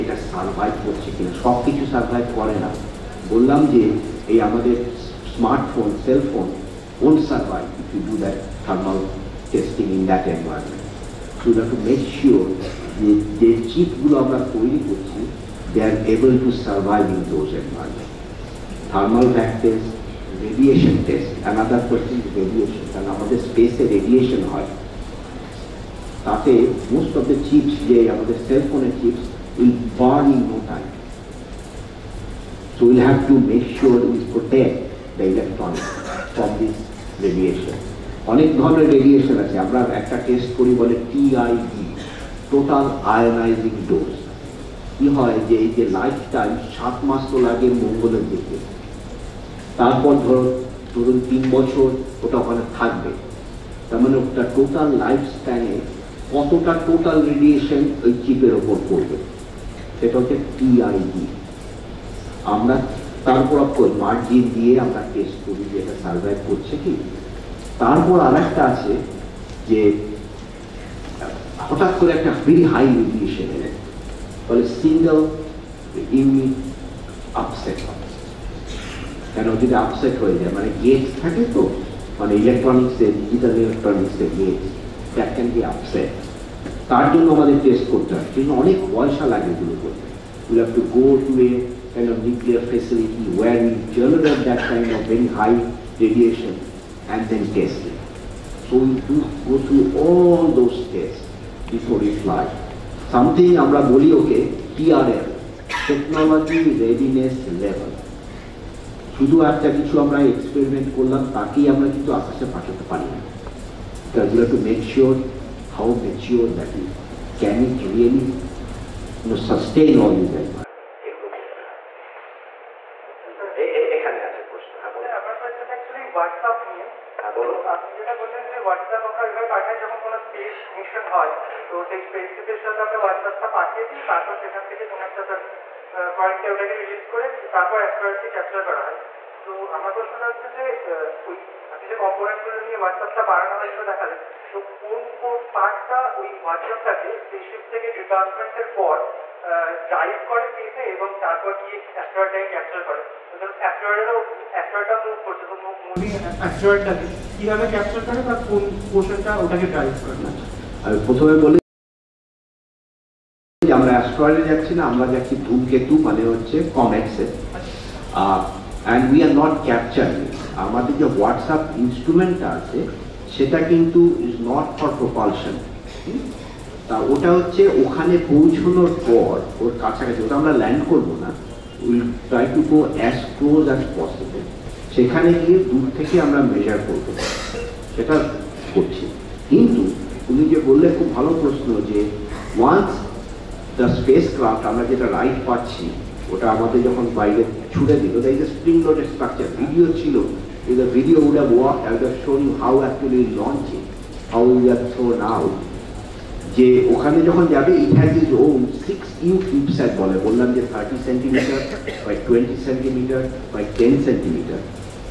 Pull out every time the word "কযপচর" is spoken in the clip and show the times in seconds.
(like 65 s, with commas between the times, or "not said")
138 s, 152 s, 157 s, 169 s.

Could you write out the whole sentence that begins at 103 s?
Something আমরা বলি ওকে TRL, Technology Readiness Level.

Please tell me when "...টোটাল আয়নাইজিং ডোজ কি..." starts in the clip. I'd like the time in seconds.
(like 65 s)
42 s.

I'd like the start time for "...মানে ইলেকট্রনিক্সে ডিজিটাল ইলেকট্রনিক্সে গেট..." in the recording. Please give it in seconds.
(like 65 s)
82 s.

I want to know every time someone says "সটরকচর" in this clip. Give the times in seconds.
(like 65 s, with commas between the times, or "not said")
199 s.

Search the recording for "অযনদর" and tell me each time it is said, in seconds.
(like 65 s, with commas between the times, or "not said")
21 s.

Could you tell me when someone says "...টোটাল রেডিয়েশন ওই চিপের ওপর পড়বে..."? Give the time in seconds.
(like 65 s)
56 s.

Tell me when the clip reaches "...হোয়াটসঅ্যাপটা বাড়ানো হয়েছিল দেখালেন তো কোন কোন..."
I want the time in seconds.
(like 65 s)
142 s.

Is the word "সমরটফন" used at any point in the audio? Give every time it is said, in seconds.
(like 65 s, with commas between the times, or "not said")
5 s.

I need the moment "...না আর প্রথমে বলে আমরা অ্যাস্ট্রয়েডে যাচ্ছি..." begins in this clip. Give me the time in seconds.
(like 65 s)
160 s.